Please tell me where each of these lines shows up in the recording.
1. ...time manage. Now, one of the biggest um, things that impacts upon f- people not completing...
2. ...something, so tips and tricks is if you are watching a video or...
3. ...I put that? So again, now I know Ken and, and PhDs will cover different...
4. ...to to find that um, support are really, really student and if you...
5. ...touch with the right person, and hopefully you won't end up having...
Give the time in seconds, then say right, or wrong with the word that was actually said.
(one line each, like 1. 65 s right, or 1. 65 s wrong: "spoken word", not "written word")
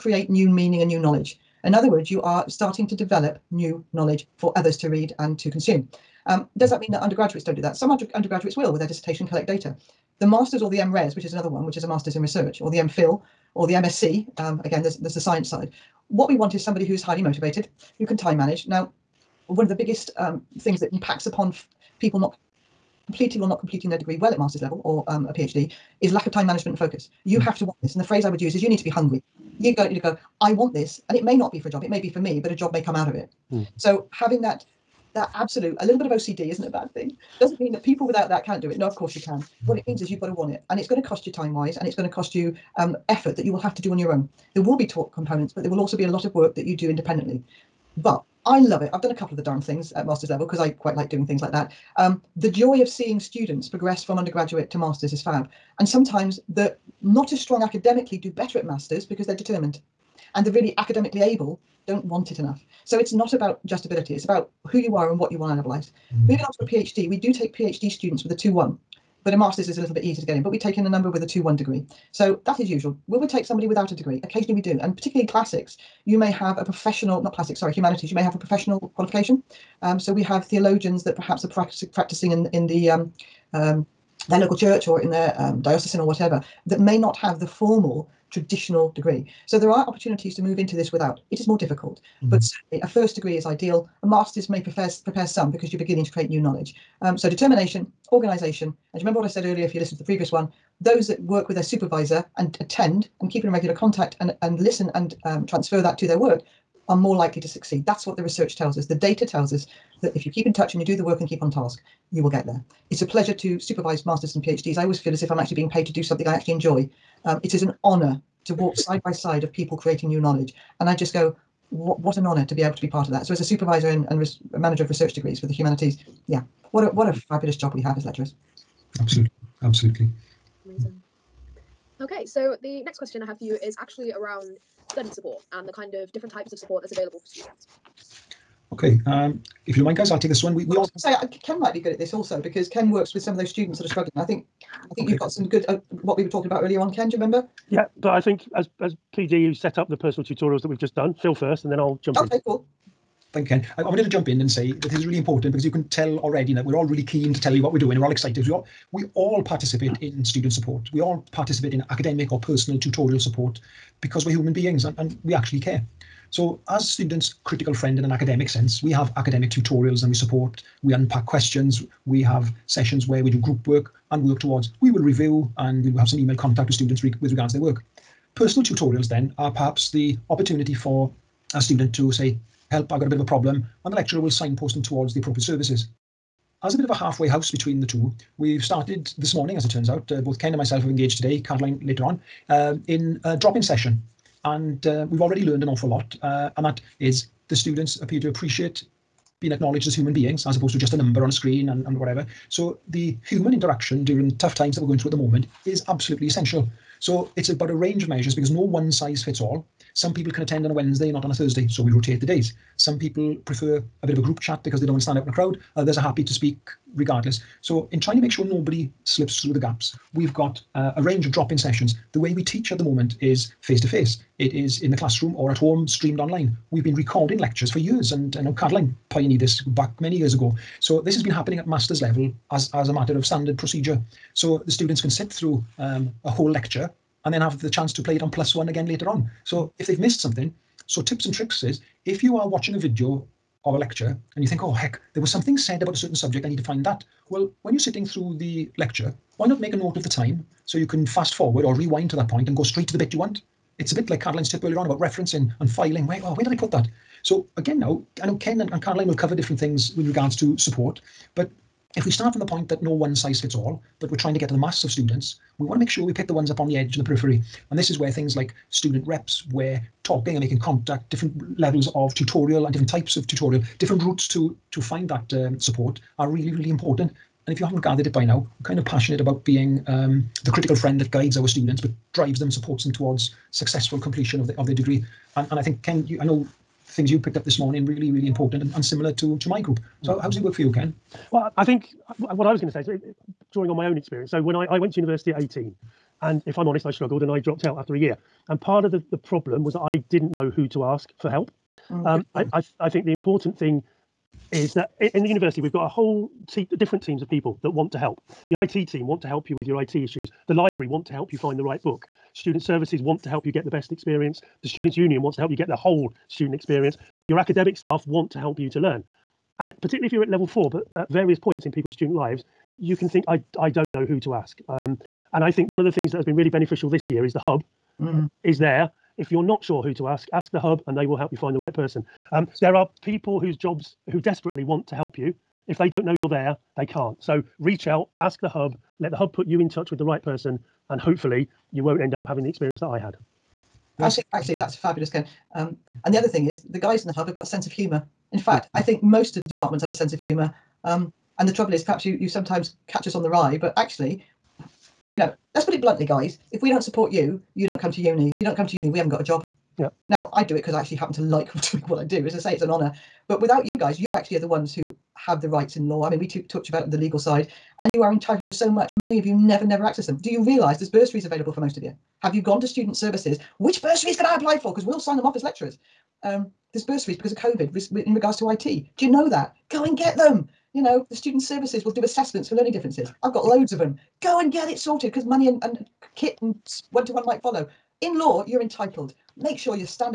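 1. 18 s right
2. 240 s right
3. 256 s wrong: "Caroline", not "PhDs"
4. 274 s wrong: "important", not "student"
5. 339 s right.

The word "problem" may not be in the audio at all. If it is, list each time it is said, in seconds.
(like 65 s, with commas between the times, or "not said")
183 s, 299 s.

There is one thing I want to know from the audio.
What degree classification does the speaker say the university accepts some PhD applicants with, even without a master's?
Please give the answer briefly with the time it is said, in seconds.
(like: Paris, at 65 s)
2:1, at 68 s.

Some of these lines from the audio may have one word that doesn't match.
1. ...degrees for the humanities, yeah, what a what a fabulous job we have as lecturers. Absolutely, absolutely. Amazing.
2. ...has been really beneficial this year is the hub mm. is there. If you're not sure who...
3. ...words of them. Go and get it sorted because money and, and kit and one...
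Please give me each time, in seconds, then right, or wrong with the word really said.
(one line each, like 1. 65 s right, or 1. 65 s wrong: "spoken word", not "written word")
1. 125 s right
2. 326 s right
3. 383 s wrong: "loads", not "words".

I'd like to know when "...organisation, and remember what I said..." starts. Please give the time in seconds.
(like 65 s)
98 s.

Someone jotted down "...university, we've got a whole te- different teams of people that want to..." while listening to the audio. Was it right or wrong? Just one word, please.
right.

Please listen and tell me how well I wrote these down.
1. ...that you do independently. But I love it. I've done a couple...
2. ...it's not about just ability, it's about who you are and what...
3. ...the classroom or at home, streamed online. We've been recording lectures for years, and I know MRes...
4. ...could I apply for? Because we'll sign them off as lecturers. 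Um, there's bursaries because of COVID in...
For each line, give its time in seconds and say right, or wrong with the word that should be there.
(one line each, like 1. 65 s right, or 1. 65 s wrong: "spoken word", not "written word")
1. 46 s right
2. 62 s right
3. 224 s wrong: "Caroline", not "MRes"
4. 374 s right.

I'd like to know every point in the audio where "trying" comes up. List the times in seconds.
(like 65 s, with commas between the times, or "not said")
217 s, 264 s.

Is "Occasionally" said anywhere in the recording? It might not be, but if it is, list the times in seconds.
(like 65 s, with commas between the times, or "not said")
74 s.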